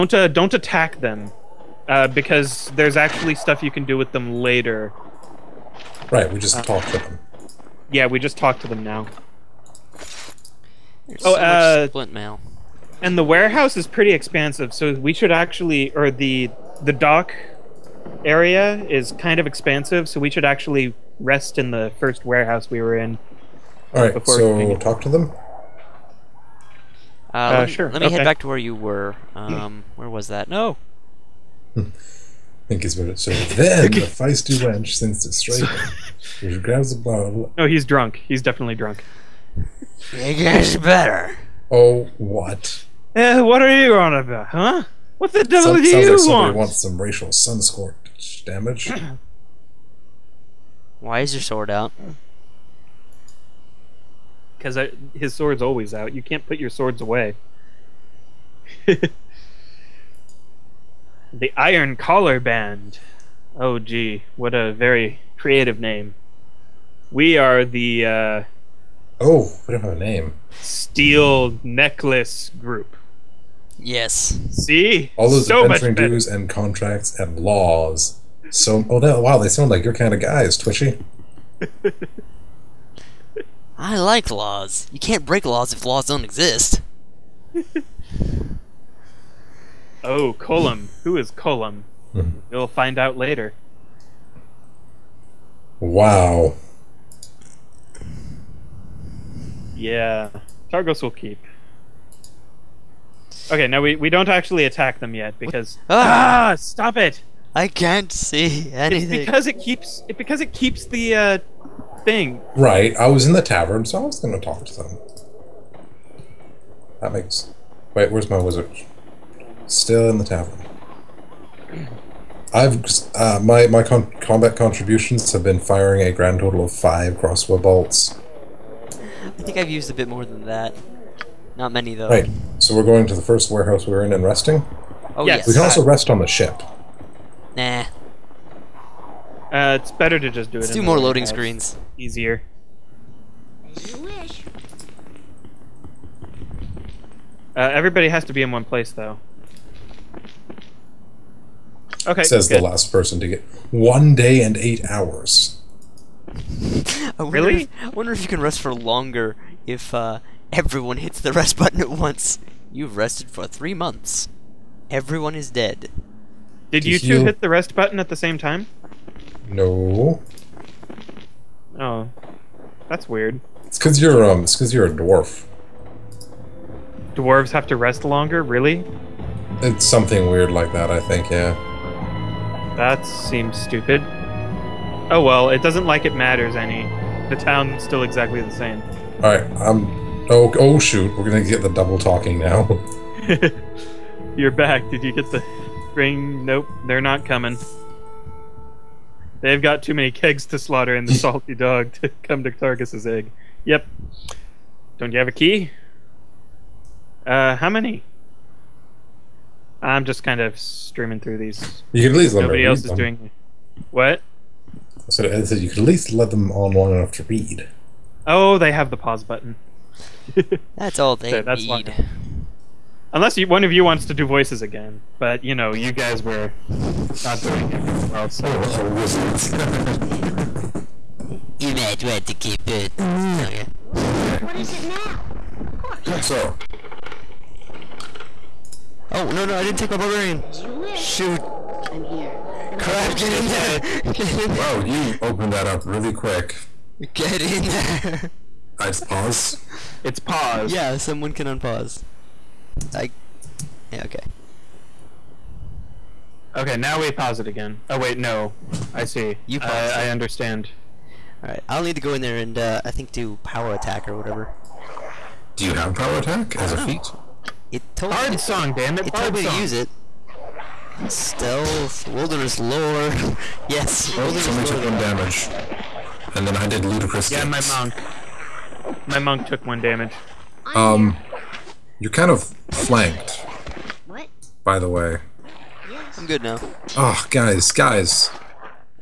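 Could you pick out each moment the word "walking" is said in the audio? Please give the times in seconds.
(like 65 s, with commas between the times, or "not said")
not said.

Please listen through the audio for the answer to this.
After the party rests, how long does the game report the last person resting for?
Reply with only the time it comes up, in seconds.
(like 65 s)
153 s.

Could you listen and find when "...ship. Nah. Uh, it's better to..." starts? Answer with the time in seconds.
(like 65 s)
136 s.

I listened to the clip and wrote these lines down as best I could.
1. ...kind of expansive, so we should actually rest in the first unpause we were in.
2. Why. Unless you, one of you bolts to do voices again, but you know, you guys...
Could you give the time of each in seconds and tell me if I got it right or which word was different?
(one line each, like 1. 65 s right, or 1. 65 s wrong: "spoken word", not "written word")
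1. 19 s wrong: "warehouse", not "unpause"
2. 221 s wrong: "wants", not "bolts".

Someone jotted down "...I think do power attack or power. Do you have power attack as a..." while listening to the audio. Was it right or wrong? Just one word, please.
wrong.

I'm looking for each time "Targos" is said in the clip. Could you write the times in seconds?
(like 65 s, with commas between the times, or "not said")
100 s, 202 s.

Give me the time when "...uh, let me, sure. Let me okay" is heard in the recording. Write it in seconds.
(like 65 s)
27 s.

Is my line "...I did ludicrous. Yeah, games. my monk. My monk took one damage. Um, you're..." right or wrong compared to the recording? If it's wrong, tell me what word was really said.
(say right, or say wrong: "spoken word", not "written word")
right.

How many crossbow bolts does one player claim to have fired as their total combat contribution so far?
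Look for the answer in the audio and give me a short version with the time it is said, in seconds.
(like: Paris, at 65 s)
5, at 126 s.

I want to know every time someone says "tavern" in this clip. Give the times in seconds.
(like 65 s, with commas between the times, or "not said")
113 s, 120 s.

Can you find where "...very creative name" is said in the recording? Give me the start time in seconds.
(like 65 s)
64 s.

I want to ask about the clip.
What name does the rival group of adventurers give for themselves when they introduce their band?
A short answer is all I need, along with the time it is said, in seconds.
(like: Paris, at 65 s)
Iron Collar Band, at 61 s.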